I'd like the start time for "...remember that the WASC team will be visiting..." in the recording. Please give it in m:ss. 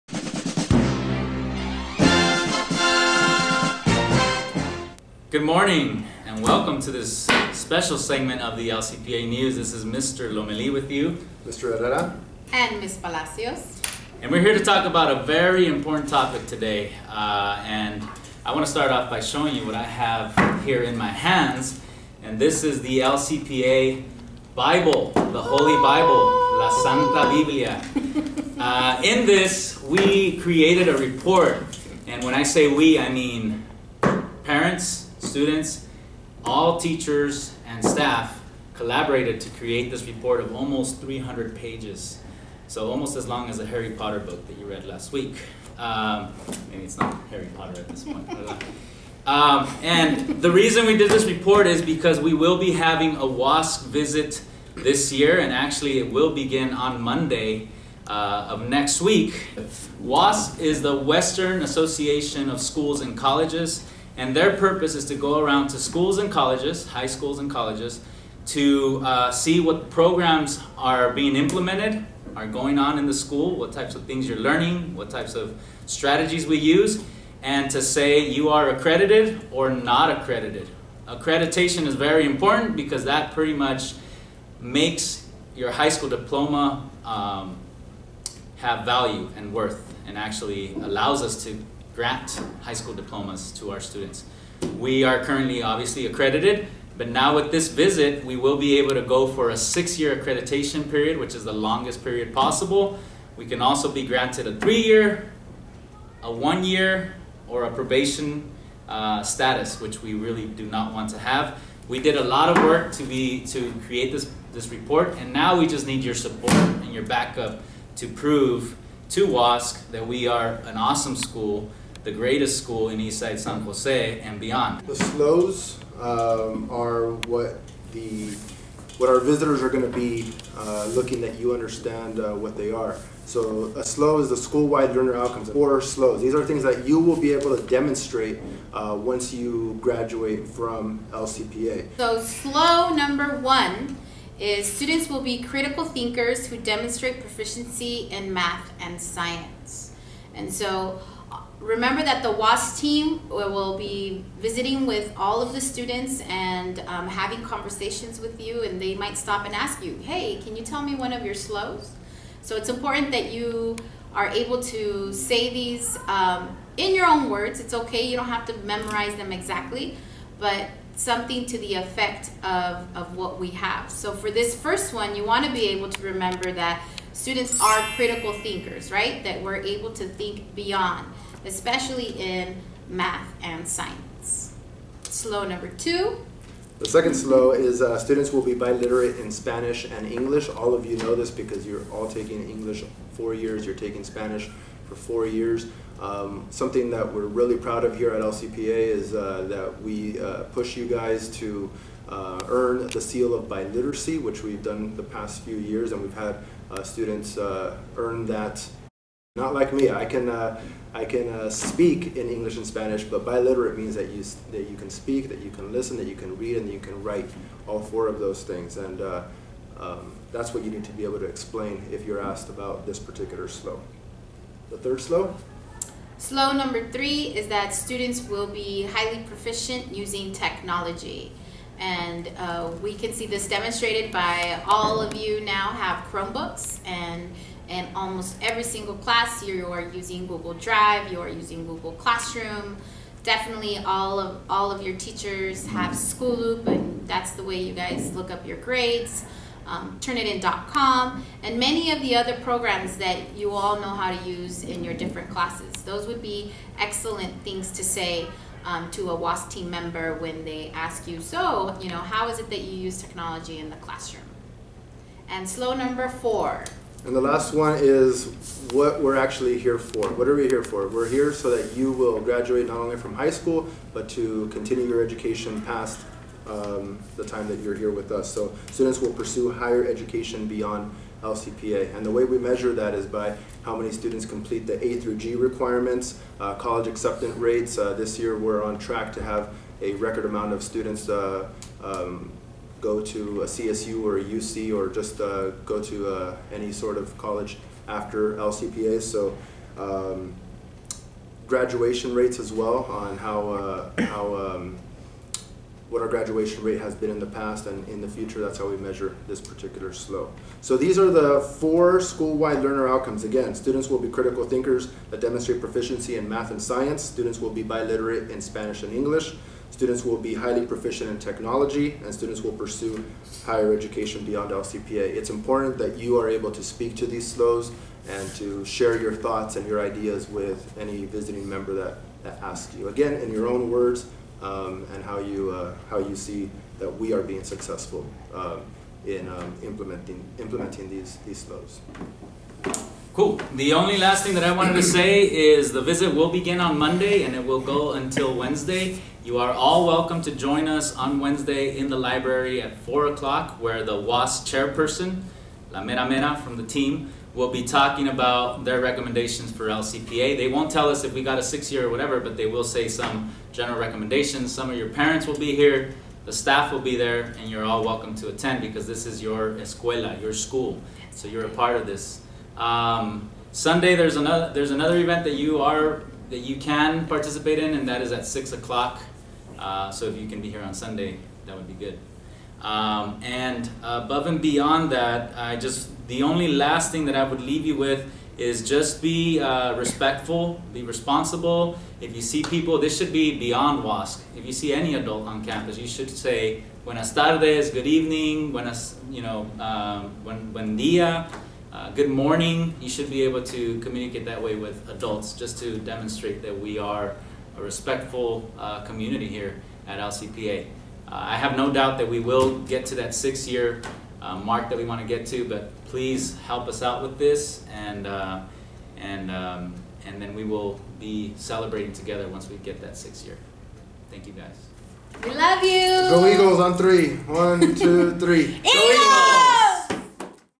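2:31.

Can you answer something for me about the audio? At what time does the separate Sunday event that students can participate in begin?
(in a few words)
6 o'clock.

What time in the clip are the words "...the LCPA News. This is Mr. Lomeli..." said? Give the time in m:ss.
0:08.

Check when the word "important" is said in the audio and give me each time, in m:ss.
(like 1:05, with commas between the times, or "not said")
0:15, 1:22, 2:42, 5:25.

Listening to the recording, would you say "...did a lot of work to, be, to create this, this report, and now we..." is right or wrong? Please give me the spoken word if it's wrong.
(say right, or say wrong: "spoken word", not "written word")
right.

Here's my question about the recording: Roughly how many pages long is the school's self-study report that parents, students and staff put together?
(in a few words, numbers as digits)
300.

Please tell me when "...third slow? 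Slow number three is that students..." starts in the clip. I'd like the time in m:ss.
3:44.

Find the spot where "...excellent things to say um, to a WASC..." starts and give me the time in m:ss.
4:16.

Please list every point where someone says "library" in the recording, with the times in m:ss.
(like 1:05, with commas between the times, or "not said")
5:51.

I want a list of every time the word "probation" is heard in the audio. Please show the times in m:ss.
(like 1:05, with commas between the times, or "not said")
1:47.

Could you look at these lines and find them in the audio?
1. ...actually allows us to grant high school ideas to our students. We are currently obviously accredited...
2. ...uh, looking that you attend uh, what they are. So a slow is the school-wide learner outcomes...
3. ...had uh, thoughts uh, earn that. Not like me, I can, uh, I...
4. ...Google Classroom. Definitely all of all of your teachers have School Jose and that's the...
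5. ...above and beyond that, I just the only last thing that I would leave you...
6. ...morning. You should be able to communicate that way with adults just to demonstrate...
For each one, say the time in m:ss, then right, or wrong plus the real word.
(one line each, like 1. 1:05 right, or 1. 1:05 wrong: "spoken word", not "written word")
1. 1:30 wrong: "diplomas", not "ideas"
2. 2:10 wrong: "understand", not "attend"
3. 3:26 wrong: "students", not "thoughts"
4. 4:01 wrong: "Loop", not "Jose"
5. 6:23 right
6. 6:42 right.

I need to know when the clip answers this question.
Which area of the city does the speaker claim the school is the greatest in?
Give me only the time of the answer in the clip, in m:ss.
2:02.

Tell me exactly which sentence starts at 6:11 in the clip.
So you're a part of this.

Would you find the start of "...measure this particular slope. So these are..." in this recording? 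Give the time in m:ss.
5:08.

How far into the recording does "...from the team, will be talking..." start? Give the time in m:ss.
5:56.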